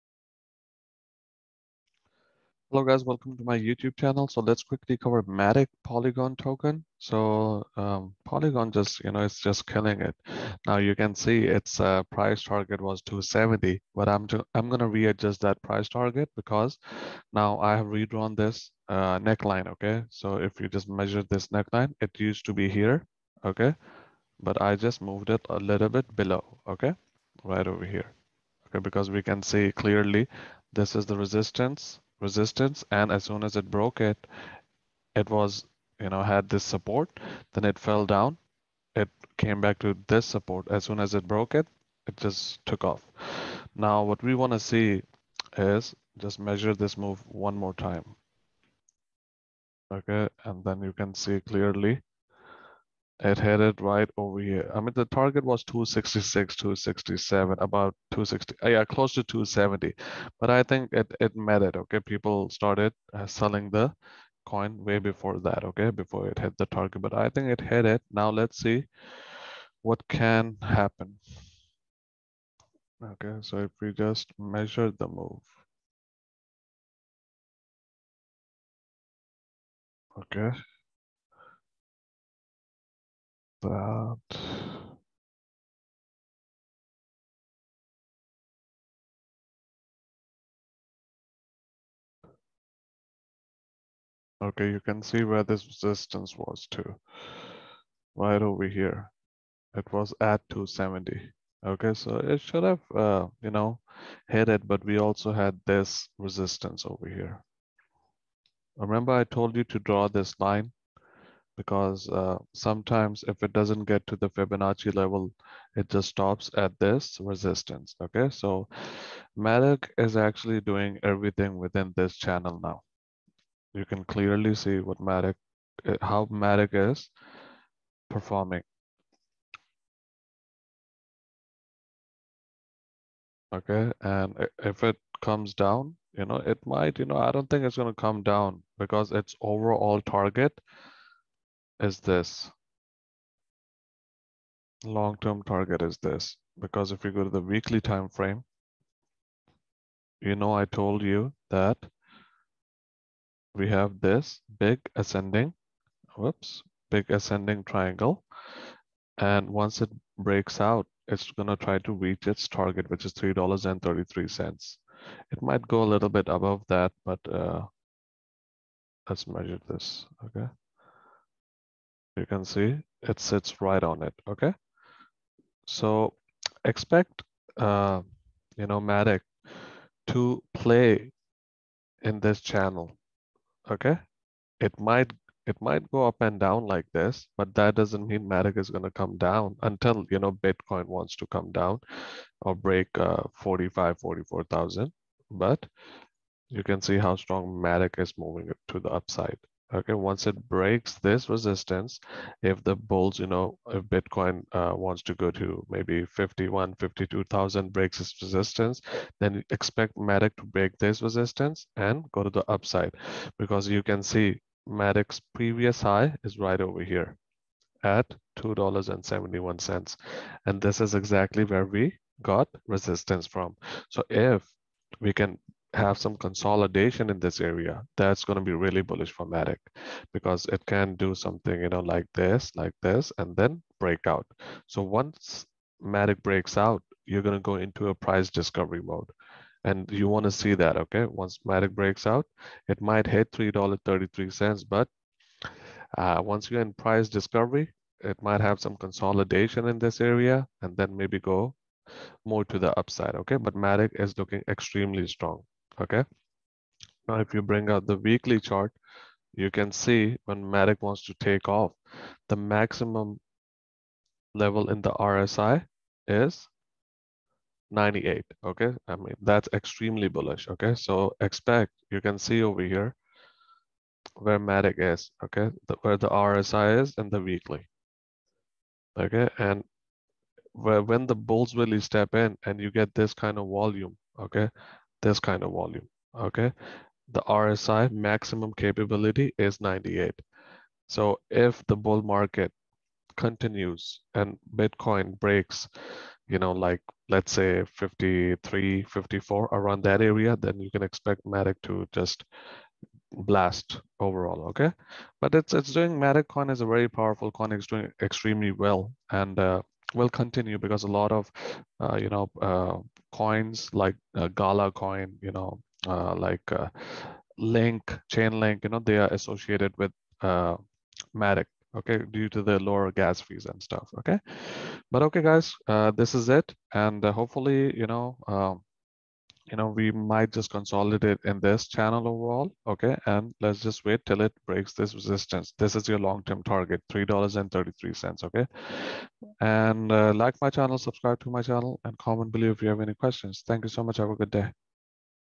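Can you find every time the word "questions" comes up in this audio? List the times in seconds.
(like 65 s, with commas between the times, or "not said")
342 s.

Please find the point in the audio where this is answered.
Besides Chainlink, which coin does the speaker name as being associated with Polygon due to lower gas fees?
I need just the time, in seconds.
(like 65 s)
314 s.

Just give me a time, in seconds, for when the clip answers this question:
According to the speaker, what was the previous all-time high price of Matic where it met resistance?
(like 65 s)
218 s.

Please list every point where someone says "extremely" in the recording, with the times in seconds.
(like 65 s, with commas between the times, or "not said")
254 s, 269 s, 308 s.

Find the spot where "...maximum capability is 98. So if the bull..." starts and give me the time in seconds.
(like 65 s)
287 s.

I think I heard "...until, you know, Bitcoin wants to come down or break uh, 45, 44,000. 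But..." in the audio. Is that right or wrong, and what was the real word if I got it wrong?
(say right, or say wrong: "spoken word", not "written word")
right.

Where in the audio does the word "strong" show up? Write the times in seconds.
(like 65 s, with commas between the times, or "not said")
197 s, 255 s.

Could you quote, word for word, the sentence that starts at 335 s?
This is your long-term target, $3.33, okay?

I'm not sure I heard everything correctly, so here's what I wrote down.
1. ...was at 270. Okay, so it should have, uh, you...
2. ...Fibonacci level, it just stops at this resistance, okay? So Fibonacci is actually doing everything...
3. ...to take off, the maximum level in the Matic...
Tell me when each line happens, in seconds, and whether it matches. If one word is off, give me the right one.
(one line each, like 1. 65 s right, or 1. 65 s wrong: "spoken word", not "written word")
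1. 99 s right
2. 114 s wrong: "Matic", not "Fibonacci"
3. 261 s wrong: "RSI", not "Matic".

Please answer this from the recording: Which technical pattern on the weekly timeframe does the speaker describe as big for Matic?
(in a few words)
Ascending triangle.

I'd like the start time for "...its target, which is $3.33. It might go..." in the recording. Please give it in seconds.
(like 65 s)
162 s.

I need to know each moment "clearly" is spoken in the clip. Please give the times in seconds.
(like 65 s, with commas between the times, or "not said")
29 s, 51 s, 124 s.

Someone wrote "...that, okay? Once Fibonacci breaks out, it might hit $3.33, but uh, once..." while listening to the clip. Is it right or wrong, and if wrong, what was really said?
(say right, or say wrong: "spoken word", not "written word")
wrong: "Matic", not "Fibonacci".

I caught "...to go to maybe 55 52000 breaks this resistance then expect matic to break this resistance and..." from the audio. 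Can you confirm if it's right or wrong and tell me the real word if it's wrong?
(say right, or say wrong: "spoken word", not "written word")
wrong: "51", not "55".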